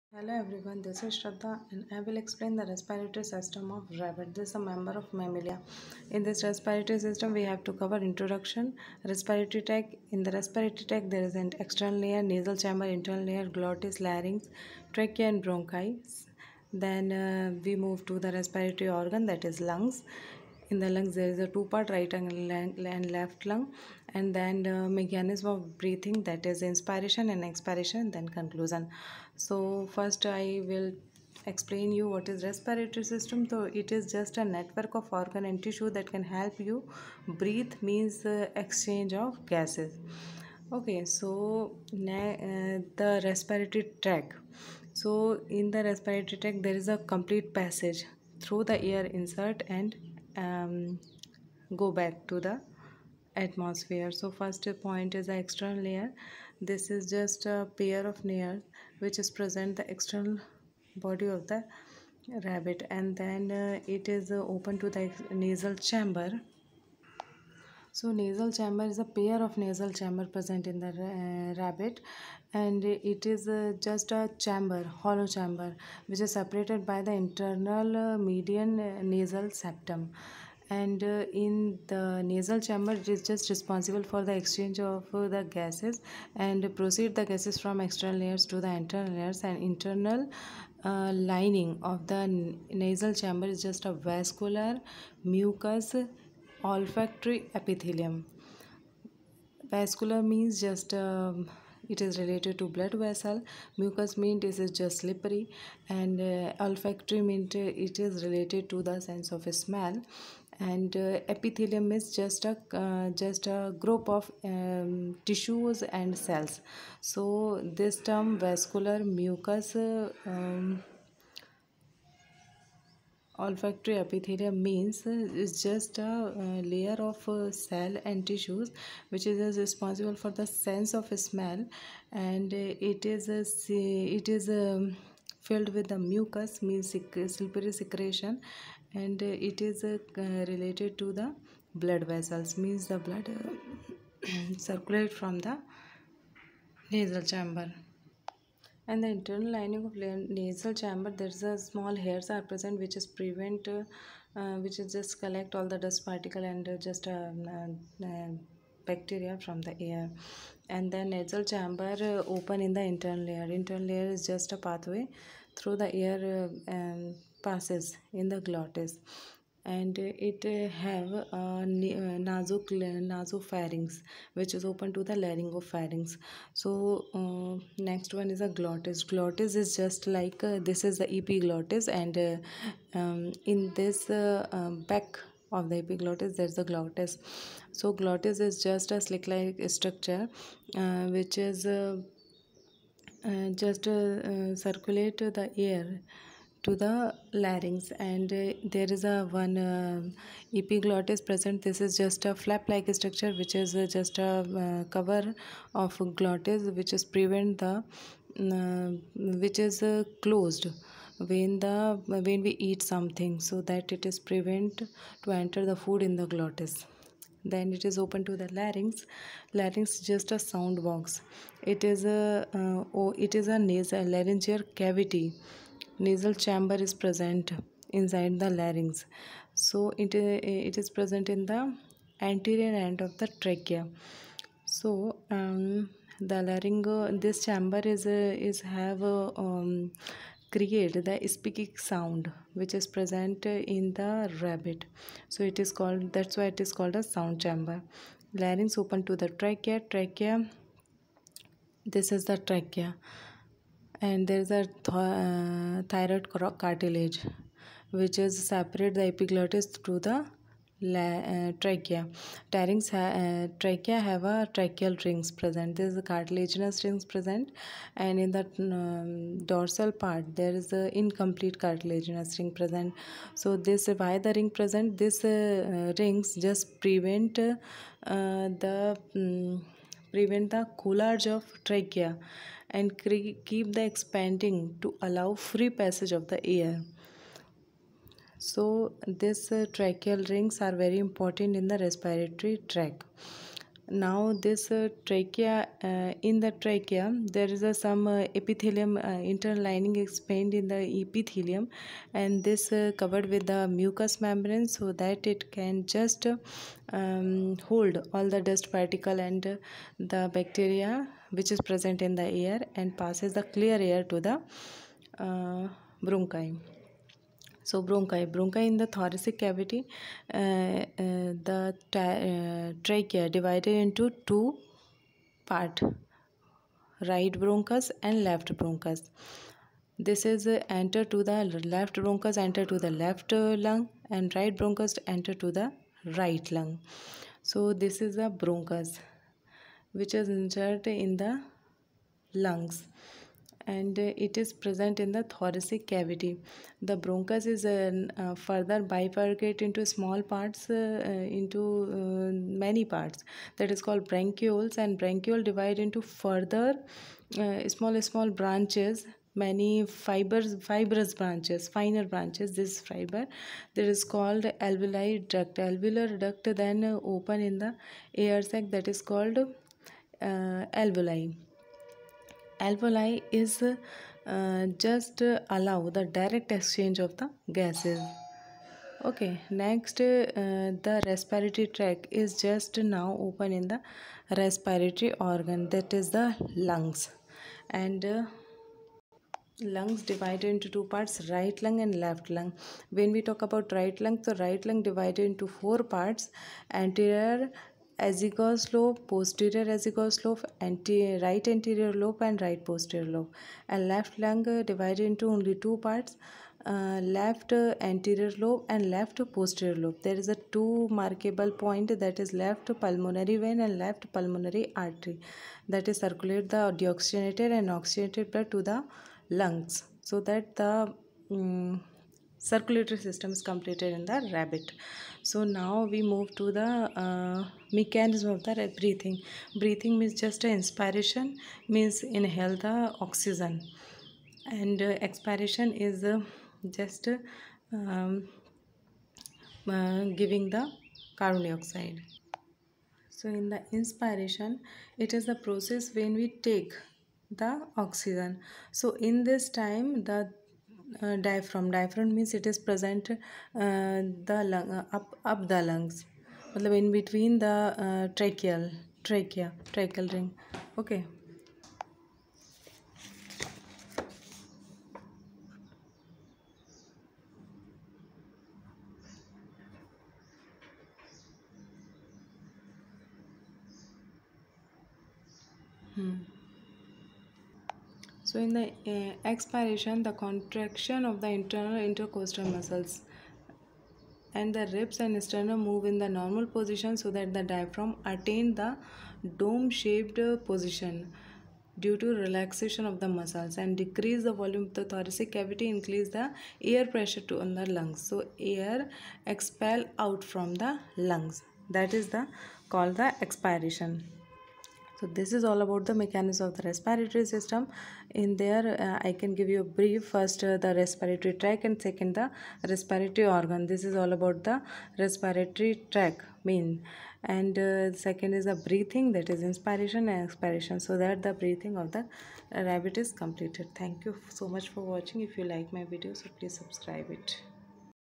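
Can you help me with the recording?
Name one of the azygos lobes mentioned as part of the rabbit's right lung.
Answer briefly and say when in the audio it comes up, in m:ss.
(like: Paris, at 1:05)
Anterior azygos lobe, at 6:36.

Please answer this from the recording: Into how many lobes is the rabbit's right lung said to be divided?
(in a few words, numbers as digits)
4.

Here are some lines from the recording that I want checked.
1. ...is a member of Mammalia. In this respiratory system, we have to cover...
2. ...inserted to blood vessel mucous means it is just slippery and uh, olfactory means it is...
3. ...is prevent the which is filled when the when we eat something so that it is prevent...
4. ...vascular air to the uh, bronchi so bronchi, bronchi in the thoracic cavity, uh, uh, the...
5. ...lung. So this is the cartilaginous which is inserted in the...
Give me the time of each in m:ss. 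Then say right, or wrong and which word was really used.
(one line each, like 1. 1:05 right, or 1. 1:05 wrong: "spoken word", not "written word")
1. 0:04 right
2. 1:42 wrong: "related", not "inserted"
3. 3:26 wrong: "closed", not "filled"
4. 5:13 wrong: "clear", not "vascular"
5. 5:36 wrong: "bronchus", not "cartilaginous".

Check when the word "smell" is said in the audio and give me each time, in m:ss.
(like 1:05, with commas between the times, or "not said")
1:49, 2:11.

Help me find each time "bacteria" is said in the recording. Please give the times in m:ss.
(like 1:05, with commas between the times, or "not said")
2:38, 5:10.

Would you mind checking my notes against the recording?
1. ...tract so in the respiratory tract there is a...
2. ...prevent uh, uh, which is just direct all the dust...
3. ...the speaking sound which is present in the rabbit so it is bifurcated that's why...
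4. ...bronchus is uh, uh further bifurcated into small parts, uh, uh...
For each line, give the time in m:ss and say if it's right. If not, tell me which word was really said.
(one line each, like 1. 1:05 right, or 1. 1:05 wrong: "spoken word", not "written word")
1. 0:44 right
2. 2:33 wrong: "collect", not "direct"
3. 4:01 wrong: "called", not "bifurcated"
4. 5:46 right.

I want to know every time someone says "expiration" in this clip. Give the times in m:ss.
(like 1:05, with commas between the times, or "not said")
0:27, 7:15, 7:59, 8:23, 8:40.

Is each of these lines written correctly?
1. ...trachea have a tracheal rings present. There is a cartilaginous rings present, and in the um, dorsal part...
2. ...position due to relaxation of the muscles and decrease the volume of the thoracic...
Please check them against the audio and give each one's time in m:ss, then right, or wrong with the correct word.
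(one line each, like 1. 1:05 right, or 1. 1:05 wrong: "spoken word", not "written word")
1. 4:23 right
2. 8:10 right.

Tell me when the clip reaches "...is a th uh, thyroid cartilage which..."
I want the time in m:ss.
4:14.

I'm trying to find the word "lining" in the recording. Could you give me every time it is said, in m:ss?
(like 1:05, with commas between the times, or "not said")
1:31, 2:29, 4:59.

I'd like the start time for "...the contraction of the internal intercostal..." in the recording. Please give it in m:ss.
8:00.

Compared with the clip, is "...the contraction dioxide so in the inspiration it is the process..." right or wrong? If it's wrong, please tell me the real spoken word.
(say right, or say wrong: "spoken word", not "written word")
wrong: "carbon", not "contraction".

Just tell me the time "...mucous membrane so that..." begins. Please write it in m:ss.
5:03.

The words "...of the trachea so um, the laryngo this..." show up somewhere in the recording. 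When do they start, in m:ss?
3:53.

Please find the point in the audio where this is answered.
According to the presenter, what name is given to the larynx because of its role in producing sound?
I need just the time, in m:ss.
3:40.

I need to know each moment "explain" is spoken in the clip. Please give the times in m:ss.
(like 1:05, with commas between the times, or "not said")
0:02, 0:31.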